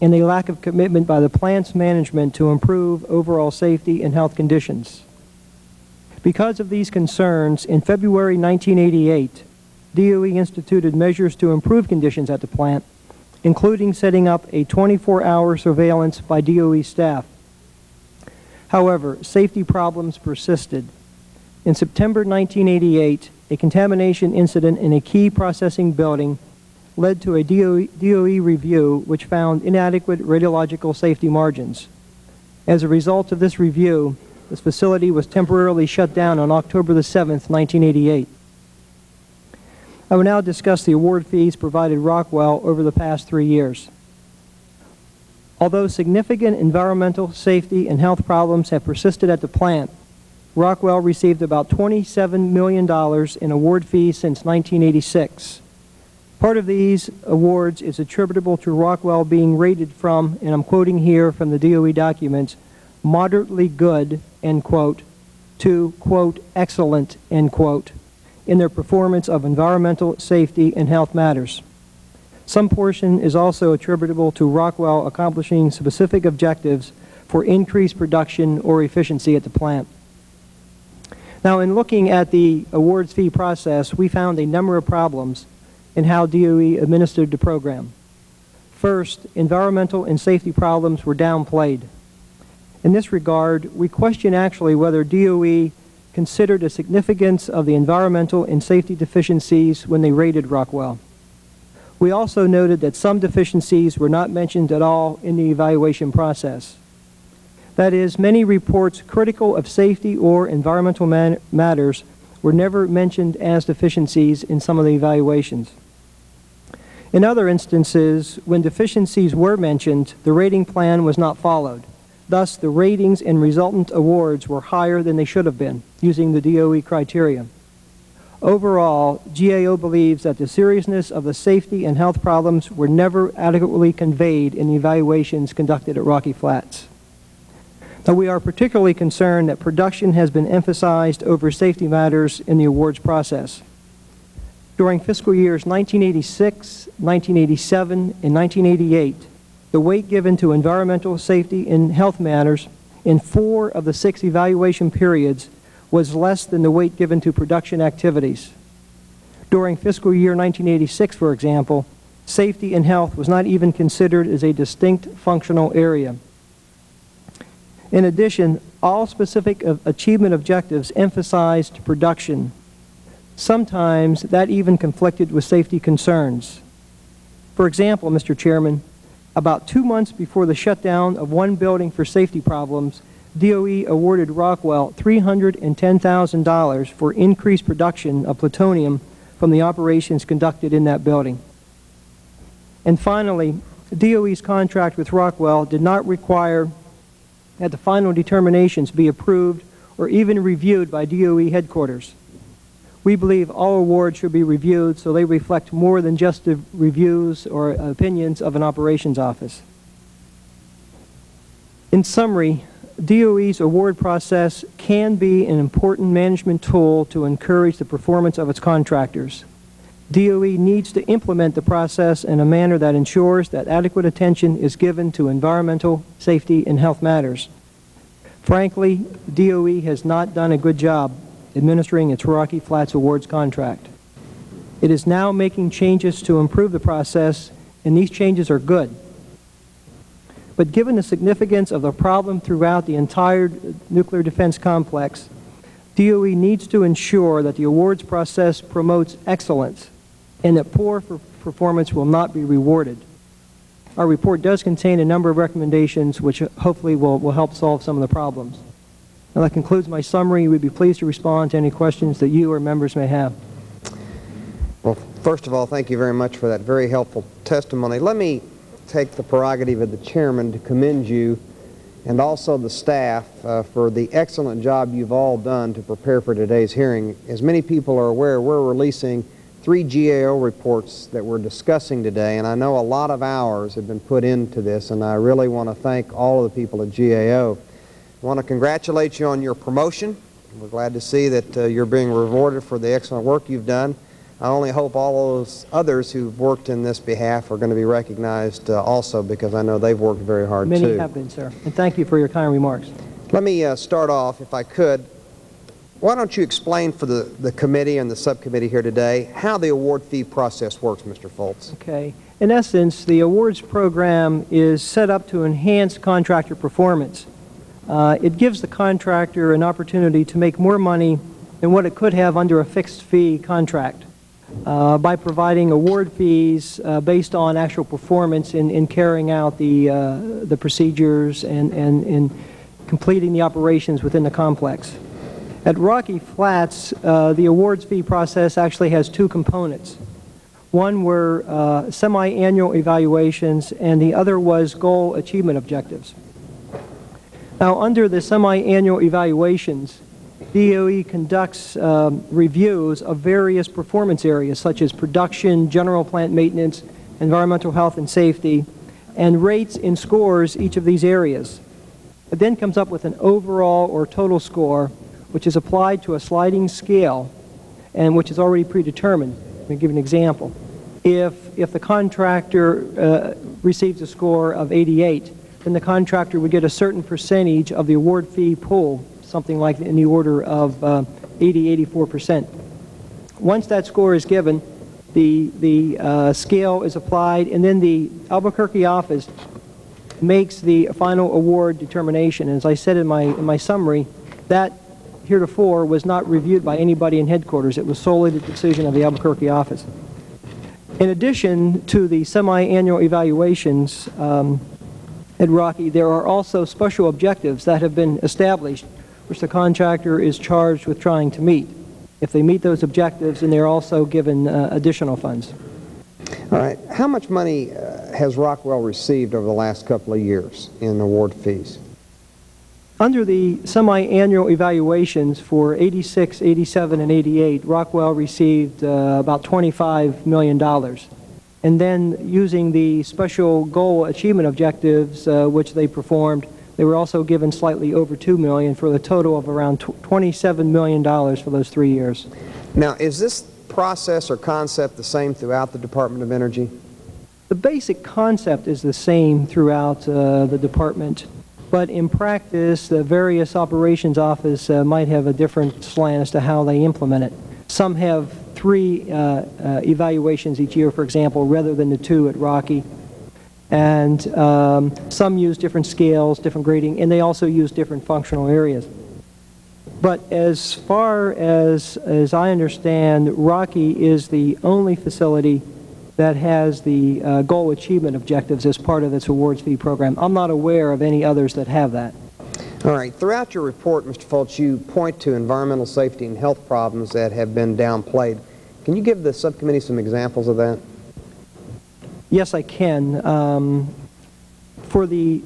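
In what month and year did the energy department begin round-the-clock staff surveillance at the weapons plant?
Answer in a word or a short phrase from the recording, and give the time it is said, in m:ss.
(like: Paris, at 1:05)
February 1988, at 0:07.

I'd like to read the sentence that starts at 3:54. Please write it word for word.
It is now making changes to improve the process, and these changes are good.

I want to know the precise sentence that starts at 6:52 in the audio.
If they meet those objectives, and they're also given uh, additional funds.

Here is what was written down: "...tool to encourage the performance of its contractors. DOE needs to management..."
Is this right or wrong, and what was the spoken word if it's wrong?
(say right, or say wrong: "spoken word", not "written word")
wrong: "implement", not "management".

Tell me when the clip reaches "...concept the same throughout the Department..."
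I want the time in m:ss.
7:24.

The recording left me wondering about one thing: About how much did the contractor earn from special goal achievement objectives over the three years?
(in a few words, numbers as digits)
slightly over $2 million.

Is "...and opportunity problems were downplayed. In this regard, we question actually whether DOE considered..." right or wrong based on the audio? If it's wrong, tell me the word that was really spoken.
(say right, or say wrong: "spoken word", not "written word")
wrong: "safety", not "opportunity".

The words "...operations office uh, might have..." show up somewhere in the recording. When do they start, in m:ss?
7:33.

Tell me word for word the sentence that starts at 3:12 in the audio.
And finally, DOE's contract with Rockwell did not require that the final determinations be approved or even reviewed by DOE headquarters.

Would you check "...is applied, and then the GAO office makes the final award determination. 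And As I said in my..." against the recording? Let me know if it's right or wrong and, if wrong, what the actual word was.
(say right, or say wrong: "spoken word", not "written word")
wrong: "Albuquerque", not "GAO".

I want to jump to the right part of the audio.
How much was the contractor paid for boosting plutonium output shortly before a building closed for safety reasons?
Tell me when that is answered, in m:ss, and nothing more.
3:04.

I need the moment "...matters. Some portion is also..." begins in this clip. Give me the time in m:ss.
1:11.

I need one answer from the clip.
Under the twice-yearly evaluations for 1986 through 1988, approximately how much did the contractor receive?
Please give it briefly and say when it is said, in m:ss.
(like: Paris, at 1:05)
$25 million, at 7:09.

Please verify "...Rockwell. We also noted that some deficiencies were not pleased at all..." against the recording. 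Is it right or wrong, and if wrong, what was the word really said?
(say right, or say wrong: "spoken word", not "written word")
wrong: "mentioned", not "pleased".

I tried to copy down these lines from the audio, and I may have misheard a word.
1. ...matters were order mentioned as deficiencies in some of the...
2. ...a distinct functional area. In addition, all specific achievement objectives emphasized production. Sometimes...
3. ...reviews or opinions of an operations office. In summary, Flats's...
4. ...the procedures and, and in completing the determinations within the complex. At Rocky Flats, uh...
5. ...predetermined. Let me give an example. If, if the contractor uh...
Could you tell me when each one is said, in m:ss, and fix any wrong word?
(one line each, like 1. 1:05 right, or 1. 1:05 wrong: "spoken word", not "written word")
1. 1:51 wrong: "never", not "order"
2. 2:44 right
3. 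3:26 wrong: "DOE", not "Flats"
4. 5:30 wrong: "operations", not "determinations"
5. 6:08 right.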